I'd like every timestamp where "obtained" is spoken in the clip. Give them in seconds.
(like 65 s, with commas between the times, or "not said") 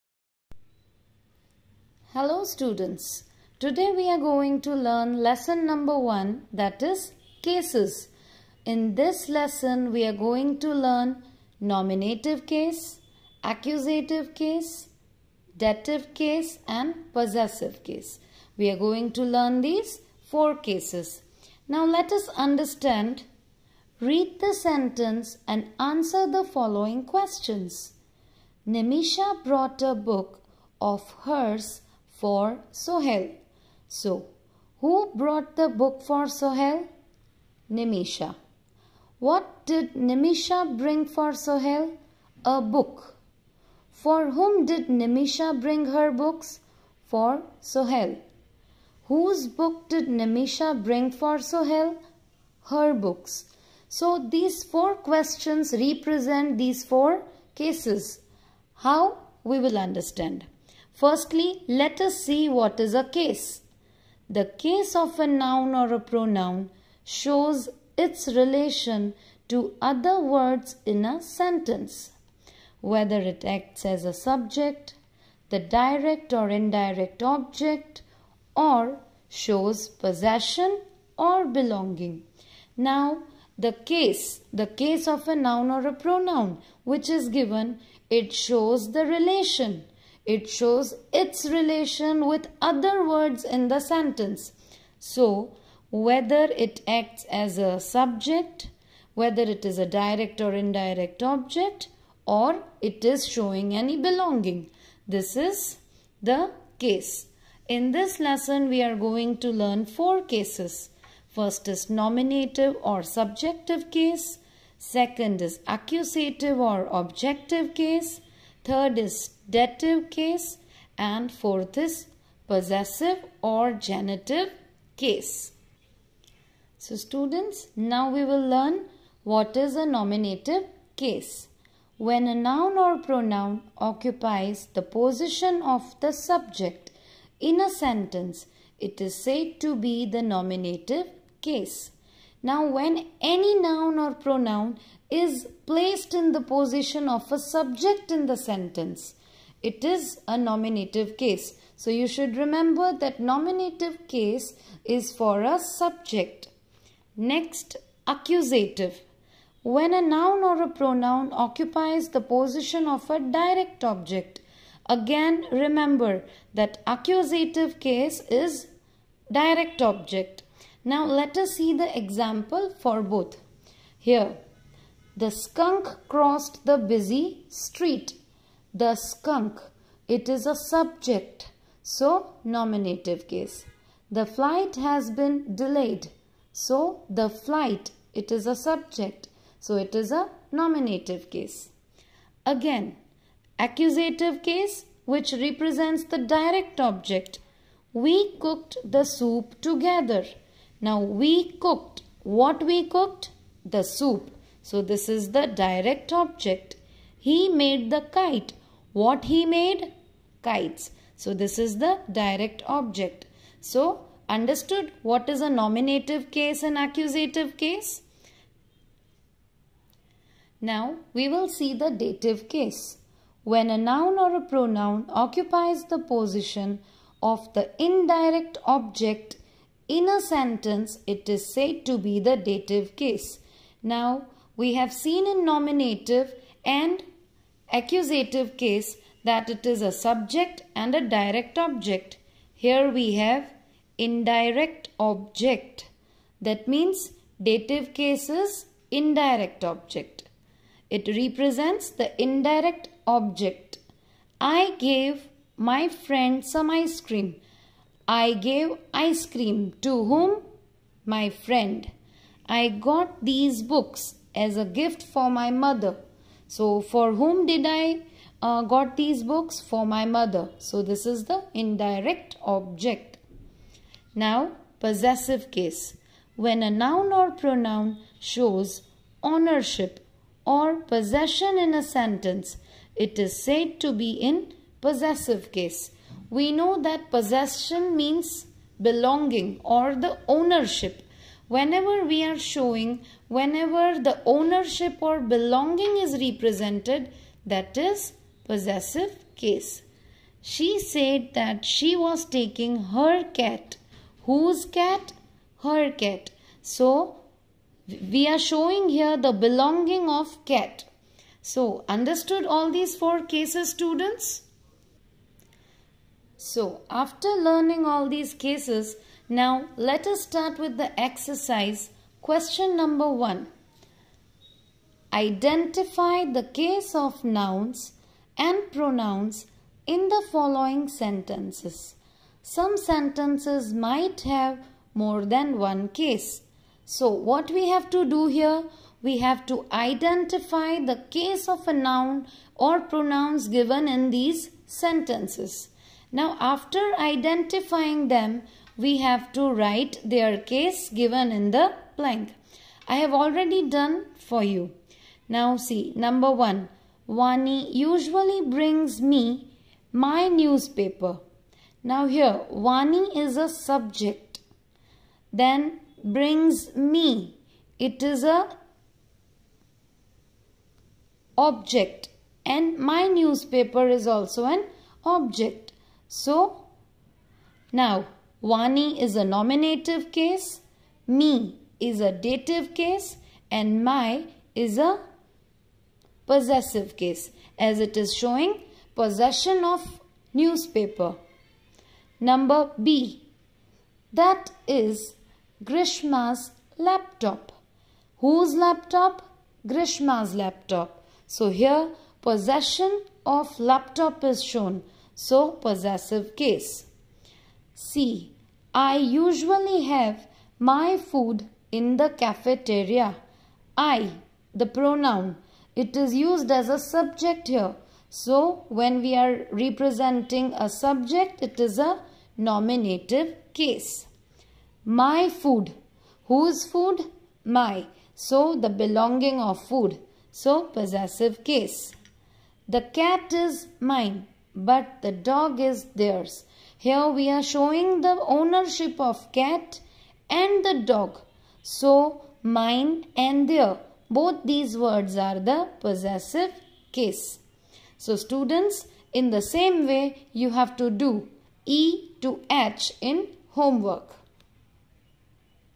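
not said.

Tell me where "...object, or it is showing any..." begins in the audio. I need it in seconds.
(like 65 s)
101 s.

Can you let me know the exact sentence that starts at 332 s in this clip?
Some sentences might have more than one case.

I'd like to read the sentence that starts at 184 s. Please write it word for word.
The flight has been delayed, so the flight, it is a subject, so it is a nominative case.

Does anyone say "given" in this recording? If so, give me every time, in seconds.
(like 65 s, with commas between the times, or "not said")
87 s, 343 s, 350 s.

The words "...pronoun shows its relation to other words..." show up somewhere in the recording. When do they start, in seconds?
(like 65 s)
66 s.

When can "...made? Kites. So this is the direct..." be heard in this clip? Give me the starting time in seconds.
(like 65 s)
209 s.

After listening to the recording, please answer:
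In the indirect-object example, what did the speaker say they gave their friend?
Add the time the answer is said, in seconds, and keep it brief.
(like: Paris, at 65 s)
Some ice cream, at 256 s.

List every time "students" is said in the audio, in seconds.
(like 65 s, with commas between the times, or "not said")
2 s, 126 s, 313 s, 448 s.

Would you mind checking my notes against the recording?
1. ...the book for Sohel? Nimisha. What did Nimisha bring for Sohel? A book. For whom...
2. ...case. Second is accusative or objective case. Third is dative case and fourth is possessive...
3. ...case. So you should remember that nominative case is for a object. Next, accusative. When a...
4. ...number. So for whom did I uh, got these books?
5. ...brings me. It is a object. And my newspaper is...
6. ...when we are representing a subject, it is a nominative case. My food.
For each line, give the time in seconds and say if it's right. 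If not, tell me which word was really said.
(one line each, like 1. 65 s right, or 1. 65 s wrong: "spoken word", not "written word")
1. 35 s right
2. 113 s right
3. 151 s wrong: "subject", not "object"
4. 265 s wrong: "mother", not "number"
5. 366 s right
6. 418 s right.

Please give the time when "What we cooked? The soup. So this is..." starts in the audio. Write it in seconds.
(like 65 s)
202 s.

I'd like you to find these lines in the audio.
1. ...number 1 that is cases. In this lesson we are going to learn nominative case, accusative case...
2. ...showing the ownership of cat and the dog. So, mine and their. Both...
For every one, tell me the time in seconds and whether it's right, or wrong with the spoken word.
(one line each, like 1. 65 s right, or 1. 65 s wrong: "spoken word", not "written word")
1. 5 s right
2. 437 s right.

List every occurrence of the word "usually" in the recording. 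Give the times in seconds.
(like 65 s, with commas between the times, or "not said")
357 s, 408 s.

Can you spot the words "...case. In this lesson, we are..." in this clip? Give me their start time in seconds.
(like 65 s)
106 s.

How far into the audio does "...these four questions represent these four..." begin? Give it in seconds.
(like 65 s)
54 s.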